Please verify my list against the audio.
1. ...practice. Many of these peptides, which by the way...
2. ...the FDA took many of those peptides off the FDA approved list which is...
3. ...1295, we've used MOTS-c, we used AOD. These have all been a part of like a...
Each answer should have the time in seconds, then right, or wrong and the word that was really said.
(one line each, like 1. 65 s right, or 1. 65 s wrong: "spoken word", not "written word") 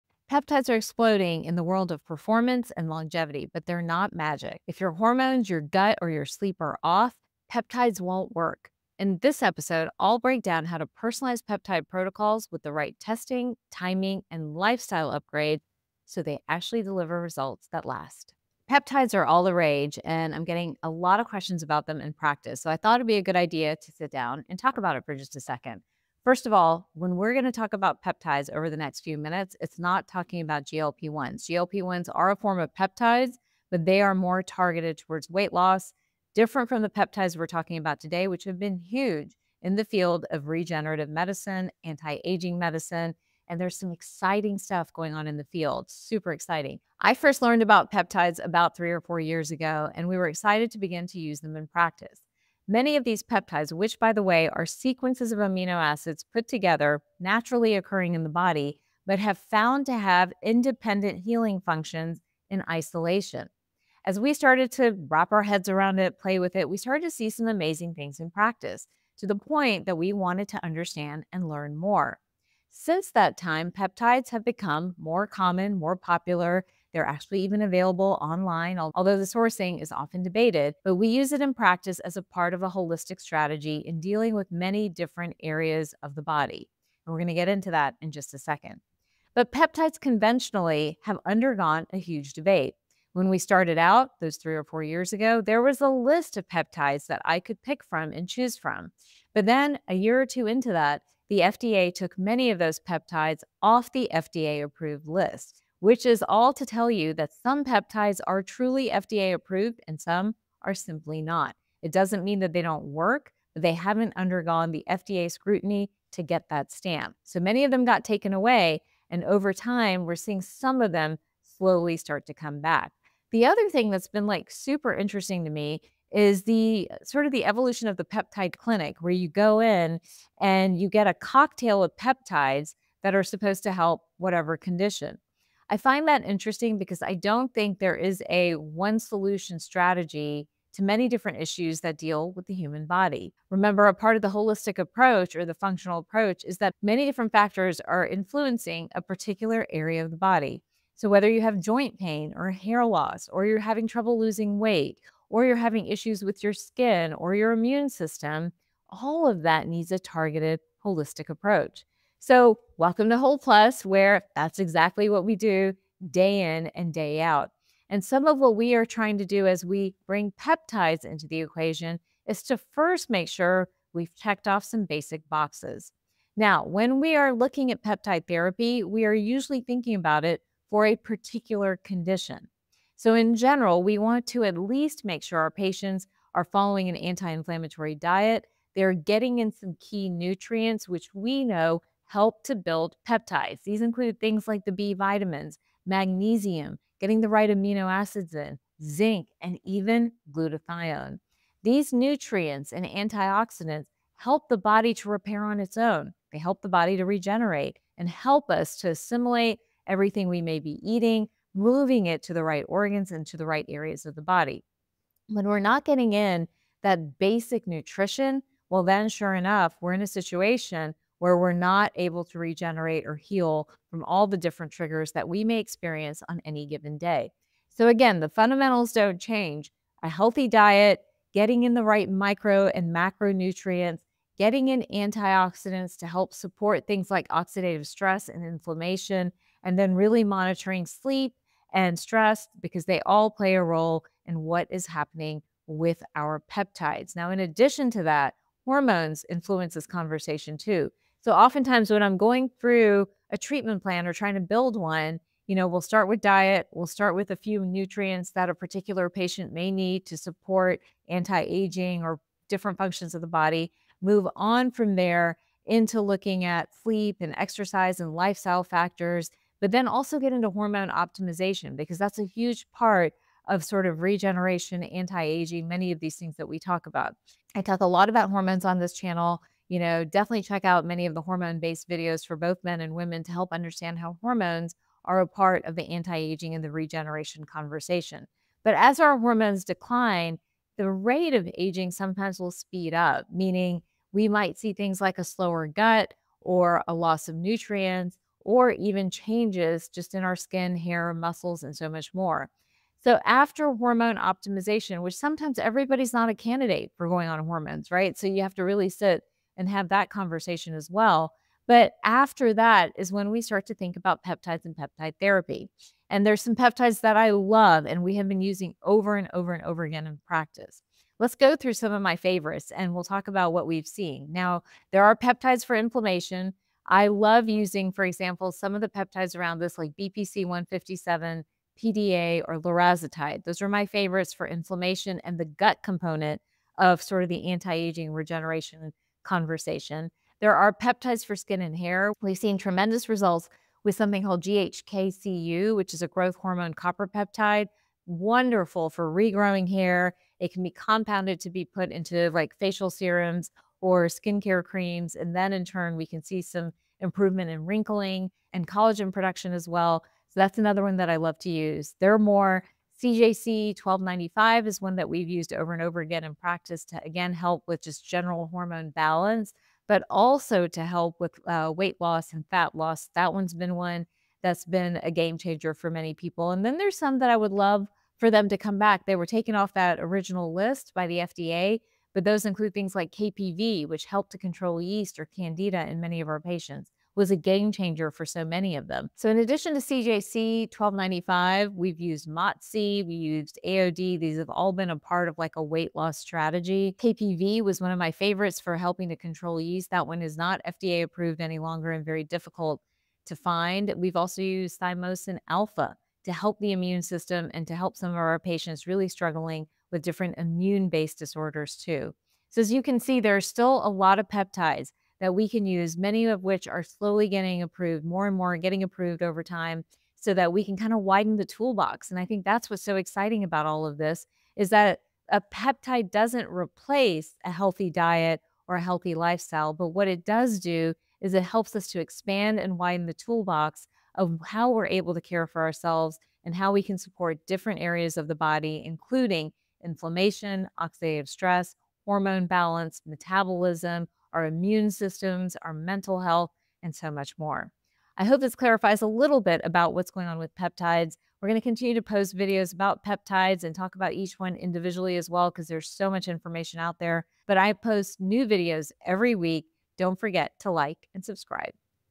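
1. 51 s right
2. 101 s right
3. 390 s right.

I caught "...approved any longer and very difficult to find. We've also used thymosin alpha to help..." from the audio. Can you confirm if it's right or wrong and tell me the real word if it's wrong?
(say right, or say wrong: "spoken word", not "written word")
right.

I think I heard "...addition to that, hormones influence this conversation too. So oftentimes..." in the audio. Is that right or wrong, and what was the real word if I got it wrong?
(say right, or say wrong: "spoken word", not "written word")
right.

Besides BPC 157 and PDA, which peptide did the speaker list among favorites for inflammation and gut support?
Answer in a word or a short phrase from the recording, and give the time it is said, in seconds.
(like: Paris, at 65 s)
Larazotide, at 332 s.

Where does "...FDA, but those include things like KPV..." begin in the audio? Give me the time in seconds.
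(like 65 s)
381 s.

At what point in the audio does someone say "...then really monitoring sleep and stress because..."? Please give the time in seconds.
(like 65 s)
239 s.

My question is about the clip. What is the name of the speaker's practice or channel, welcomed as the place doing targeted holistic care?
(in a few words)
HolPlus.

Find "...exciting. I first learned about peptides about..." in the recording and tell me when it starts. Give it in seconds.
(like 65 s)
46 s.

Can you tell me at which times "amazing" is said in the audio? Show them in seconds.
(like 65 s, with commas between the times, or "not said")
67 s.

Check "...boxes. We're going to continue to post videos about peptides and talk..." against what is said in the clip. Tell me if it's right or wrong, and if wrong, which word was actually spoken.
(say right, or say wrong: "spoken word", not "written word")
wrong: "peptides", not "boxes".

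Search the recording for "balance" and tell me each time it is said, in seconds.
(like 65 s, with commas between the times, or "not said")
368 s, 442 s.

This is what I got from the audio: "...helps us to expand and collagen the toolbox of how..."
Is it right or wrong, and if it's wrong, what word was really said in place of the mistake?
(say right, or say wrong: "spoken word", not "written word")
wrong: "widen", not "collagen".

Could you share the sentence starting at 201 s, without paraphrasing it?
These nutrients and antioxidants help the body to repair on its own.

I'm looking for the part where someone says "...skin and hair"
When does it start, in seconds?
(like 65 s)
341 s.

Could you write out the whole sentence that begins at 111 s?
It doesn't mean that they don't work, but they haven't undergone the FDA scrutiny to get that stamp.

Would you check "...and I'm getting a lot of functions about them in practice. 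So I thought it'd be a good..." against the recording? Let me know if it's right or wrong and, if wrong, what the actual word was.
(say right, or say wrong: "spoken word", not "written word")
wrong: "questions", not "functions".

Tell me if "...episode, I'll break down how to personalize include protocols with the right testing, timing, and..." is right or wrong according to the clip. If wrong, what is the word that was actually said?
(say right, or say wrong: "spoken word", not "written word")
wrong: "peptide", not "include".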